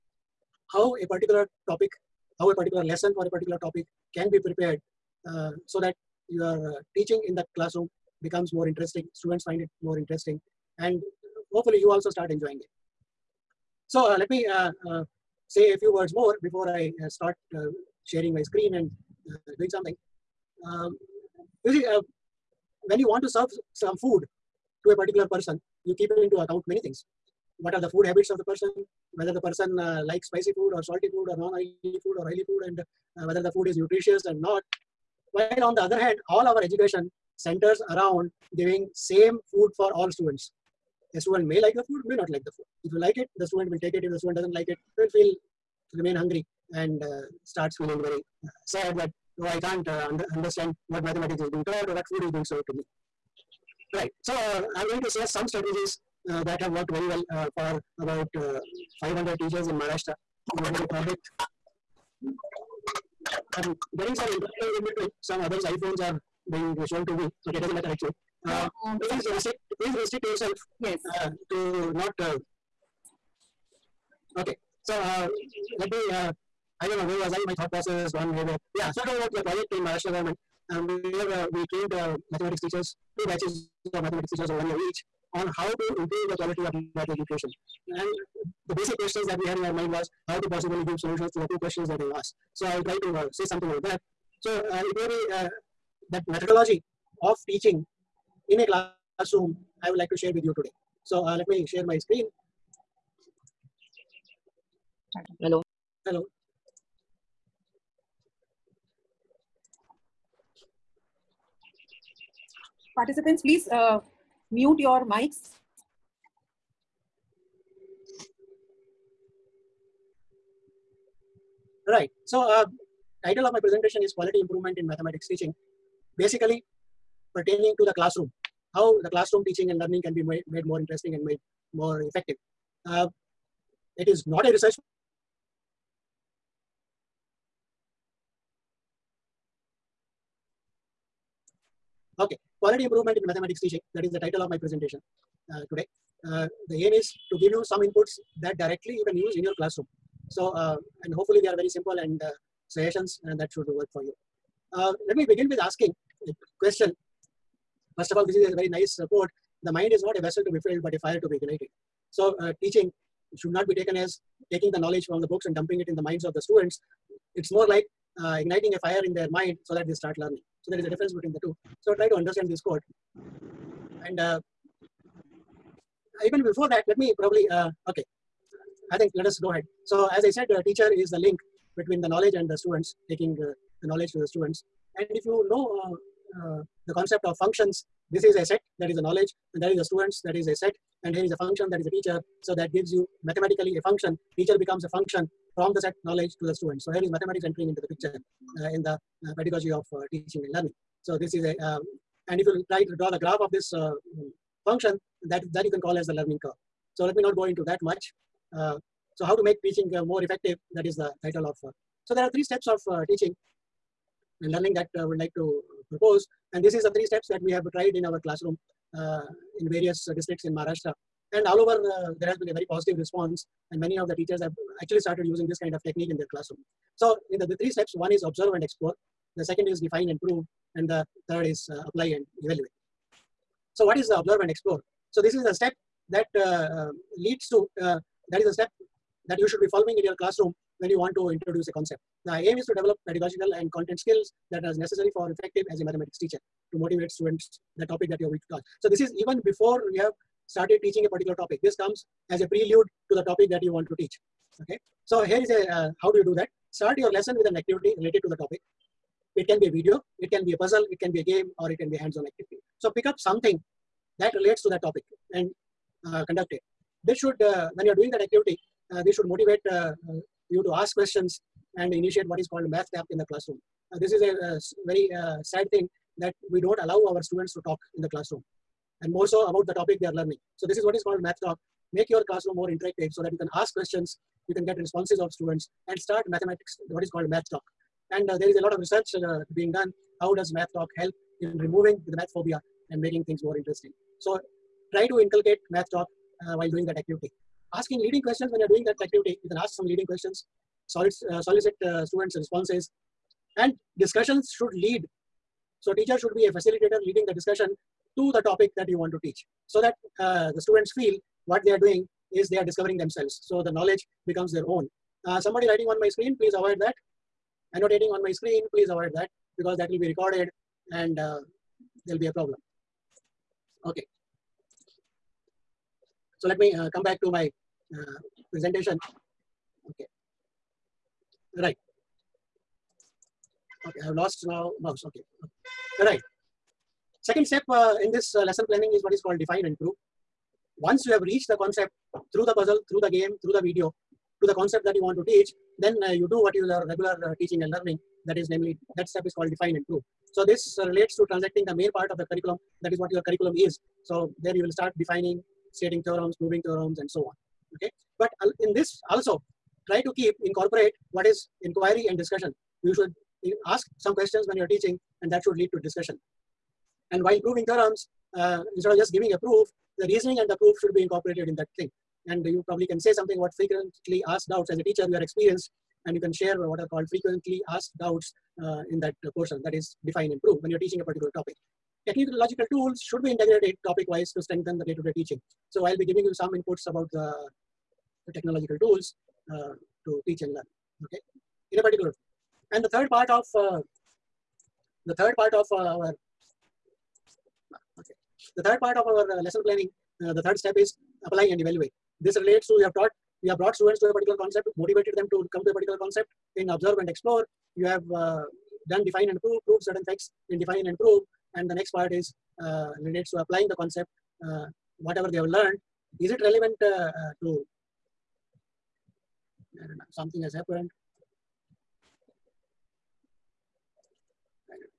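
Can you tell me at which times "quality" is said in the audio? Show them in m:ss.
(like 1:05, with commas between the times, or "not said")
1:26, 2:04, 2:22.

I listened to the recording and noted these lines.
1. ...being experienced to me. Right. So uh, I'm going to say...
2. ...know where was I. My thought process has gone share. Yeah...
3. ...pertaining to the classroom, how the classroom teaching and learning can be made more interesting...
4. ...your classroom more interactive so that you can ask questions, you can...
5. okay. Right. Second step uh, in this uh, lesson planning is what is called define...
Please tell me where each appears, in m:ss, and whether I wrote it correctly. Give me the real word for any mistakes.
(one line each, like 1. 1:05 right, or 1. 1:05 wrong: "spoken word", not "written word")
1. 0:52 wrong: "served", not "experienced"
2. 1:16 wrong: "haywire", not "share"
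3. 2:07 right
4. 4:42 right
5. 5:35 right.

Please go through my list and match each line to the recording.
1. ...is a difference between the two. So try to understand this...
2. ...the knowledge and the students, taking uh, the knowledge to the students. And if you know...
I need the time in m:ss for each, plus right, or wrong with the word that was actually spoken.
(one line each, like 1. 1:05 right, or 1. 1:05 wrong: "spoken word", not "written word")
1. 2:50 right
2. 3:02 right.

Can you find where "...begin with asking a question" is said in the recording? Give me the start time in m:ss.
2:35.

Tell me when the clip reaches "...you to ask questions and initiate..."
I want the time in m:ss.
4:30.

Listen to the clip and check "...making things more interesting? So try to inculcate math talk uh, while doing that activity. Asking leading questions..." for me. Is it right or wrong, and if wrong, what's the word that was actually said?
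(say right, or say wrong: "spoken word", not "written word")
right.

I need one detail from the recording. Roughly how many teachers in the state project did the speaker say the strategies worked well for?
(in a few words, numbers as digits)
500.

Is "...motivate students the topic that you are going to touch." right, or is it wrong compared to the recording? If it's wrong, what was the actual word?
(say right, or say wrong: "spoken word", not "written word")
right.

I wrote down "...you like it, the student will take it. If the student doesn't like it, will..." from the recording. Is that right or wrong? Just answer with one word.
right.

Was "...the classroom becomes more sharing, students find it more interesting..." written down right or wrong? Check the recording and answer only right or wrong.
wrong.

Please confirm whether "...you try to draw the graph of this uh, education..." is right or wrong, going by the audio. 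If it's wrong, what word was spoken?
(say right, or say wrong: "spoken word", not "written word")
wrong: "function", not "education".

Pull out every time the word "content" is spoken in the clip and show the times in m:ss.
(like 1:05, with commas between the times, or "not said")
4:03.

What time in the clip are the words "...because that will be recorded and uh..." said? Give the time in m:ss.
5:19.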